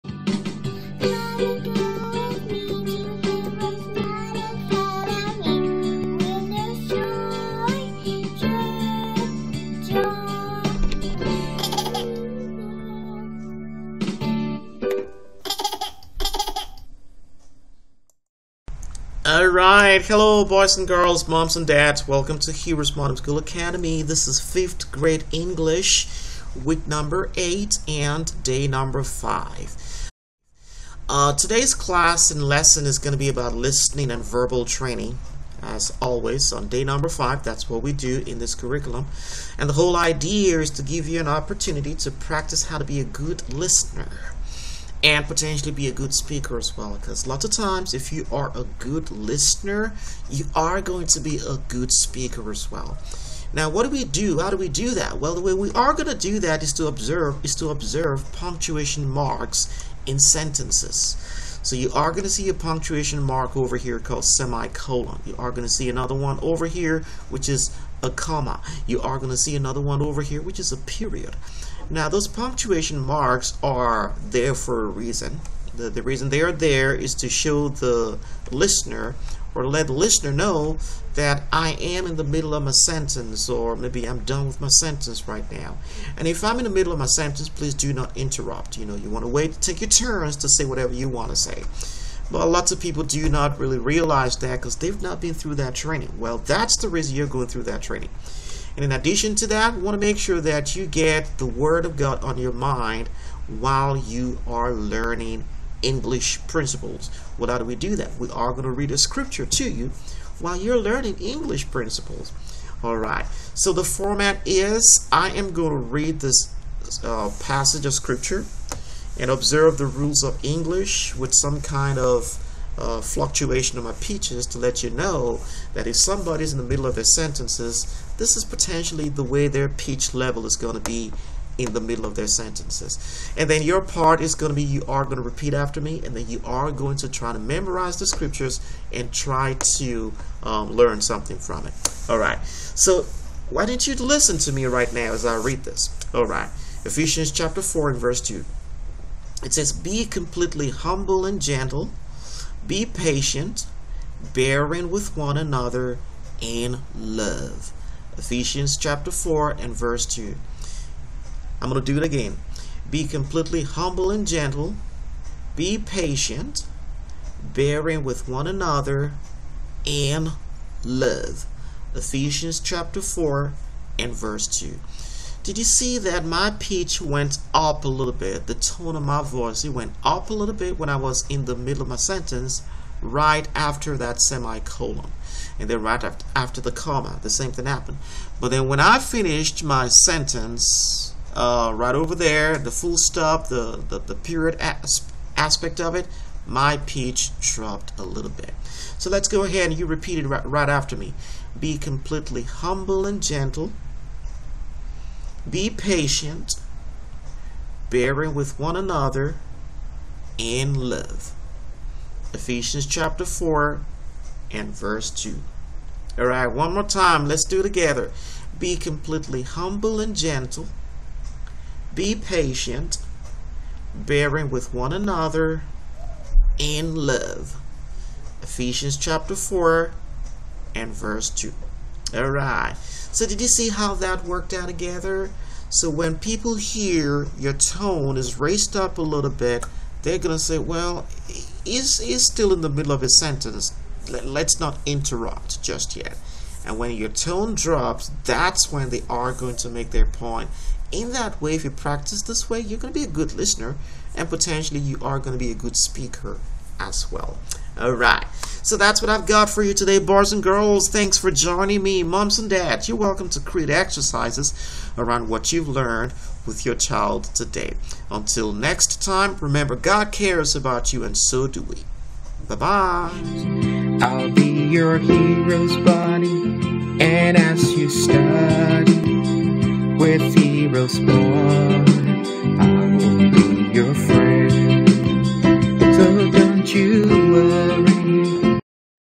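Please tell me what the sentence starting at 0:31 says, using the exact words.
Uh, today's class and lesson is going to be about listening and verbal training.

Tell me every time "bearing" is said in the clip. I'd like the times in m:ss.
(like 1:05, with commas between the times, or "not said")
2:34, 2:47, 3:27, 3:43.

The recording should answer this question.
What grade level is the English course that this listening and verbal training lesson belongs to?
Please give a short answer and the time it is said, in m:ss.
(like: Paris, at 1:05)
5th, at 0:24.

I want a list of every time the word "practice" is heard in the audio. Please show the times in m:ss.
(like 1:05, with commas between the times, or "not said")
0:42, 4:11.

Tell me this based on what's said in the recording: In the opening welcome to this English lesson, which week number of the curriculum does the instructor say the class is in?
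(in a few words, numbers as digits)
8.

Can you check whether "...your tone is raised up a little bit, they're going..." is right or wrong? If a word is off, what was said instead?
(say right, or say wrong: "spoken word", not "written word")
right.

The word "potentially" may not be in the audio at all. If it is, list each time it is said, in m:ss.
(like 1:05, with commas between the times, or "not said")
0:45, 2:08, 4:14.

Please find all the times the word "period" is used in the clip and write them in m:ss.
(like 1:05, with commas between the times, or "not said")
1:10, 3:14.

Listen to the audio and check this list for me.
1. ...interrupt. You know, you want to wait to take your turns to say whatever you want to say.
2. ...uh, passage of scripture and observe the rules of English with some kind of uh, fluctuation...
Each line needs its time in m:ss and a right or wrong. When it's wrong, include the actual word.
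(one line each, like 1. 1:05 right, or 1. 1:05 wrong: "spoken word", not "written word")
1. 1:28 right
2. 1:57 right.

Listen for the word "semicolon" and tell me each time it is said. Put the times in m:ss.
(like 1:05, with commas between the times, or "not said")
1:04, 3:04.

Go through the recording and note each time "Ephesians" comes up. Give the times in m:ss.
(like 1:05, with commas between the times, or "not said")
2:26, 2:38, 2:51, 3:32, 3:48.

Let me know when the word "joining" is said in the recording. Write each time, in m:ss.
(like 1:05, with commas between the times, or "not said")
4:21.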